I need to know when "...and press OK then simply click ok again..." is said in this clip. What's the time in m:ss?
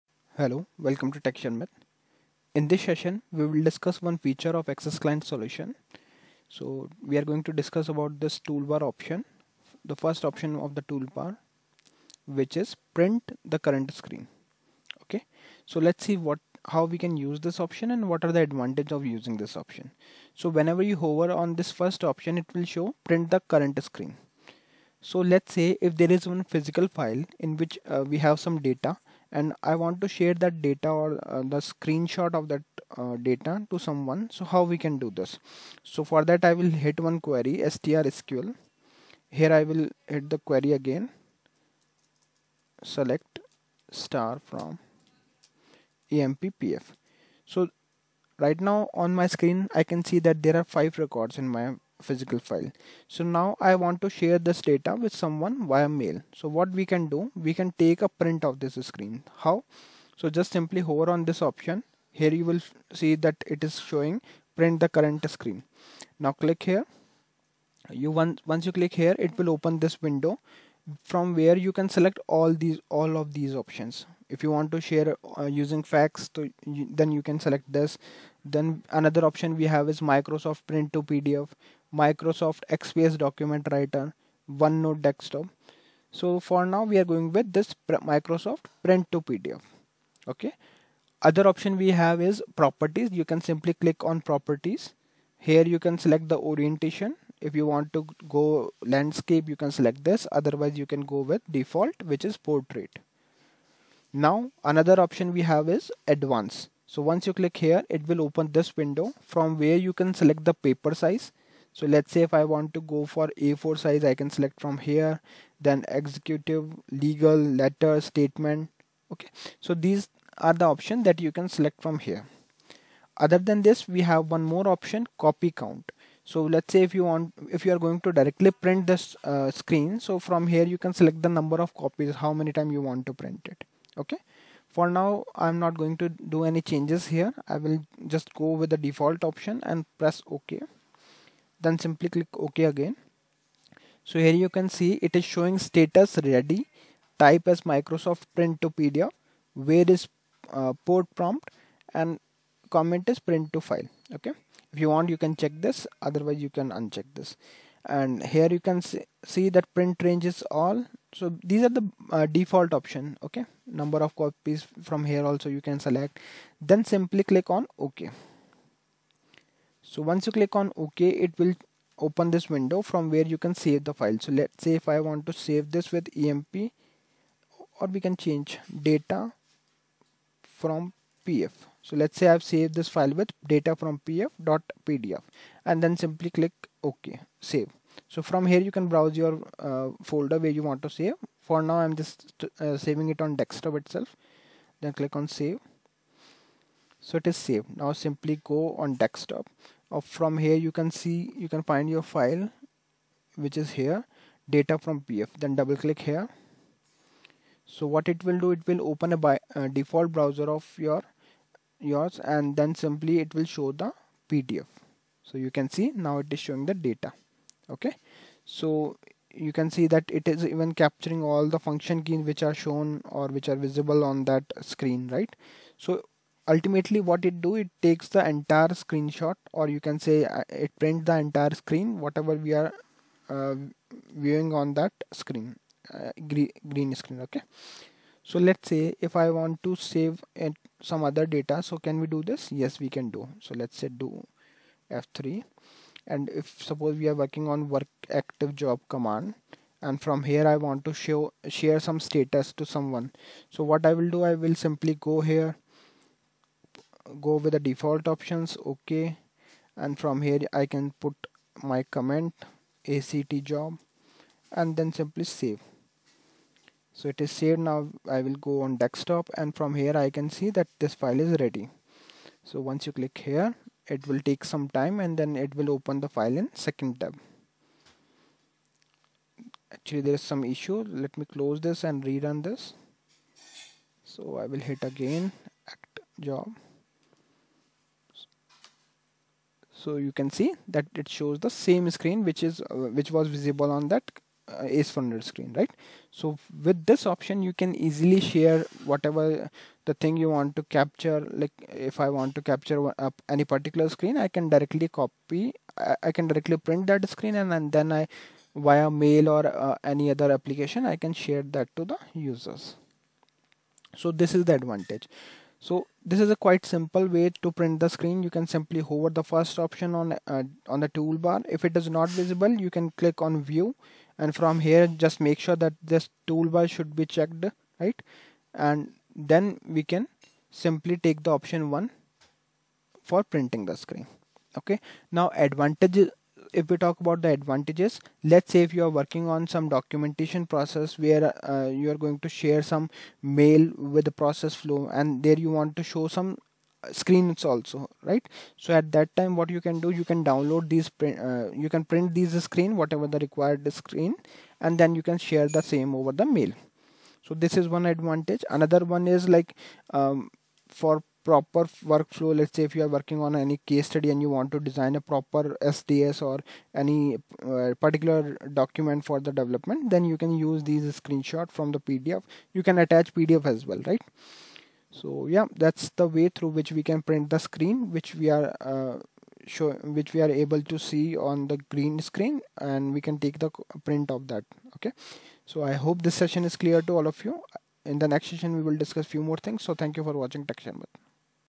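2:19.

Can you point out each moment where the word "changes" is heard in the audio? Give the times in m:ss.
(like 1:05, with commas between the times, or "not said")
2:16, 2:58.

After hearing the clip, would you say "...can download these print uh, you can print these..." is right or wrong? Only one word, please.
right.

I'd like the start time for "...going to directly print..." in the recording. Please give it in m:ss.
2:07.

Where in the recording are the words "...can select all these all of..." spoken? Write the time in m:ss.
1:11.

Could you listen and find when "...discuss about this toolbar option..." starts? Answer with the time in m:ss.
0:07.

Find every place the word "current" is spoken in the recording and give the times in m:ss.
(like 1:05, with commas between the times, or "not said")
0:13, 0:23, 1:04.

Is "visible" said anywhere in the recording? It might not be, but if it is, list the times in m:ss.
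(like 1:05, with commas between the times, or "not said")
3:43, 4:53, 5:22.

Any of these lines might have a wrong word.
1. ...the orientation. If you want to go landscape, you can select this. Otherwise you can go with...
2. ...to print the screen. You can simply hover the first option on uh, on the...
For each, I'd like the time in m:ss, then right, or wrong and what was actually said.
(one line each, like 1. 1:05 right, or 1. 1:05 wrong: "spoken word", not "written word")
1. 1:36 right
2. 5:17 right.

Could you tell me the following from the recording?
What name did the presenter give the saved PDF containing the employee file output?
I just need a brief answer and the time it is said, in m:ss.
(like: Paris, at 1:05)
data from pf.pdf, at 3:03.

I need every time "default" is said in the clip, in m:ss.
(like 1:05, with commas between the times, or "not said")
1:41, 2:18, 2:42, 3:29, 4:17.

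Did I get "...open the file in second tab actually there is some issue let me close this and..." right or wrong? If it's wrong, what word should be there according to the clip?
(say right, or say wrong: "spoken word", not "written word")
right.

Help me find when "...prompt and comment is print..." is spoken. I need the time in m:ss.
2:31.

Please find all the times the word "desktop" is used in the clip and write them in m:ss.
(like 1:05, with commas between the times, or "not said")
1:25, 3:13, 3:18, 4:28.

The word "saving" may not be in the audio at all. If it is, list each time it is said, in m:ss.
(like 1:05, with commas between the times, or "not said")
3:12.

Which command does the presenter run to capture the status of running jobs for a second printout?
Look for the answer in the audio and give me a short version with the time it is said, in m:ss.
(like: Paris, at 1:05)
work active job, at 4:07.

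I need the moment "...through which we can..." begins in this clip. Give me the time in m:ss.
6:16.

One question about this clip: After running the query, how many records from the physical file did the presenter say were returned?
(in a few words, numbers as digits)
5.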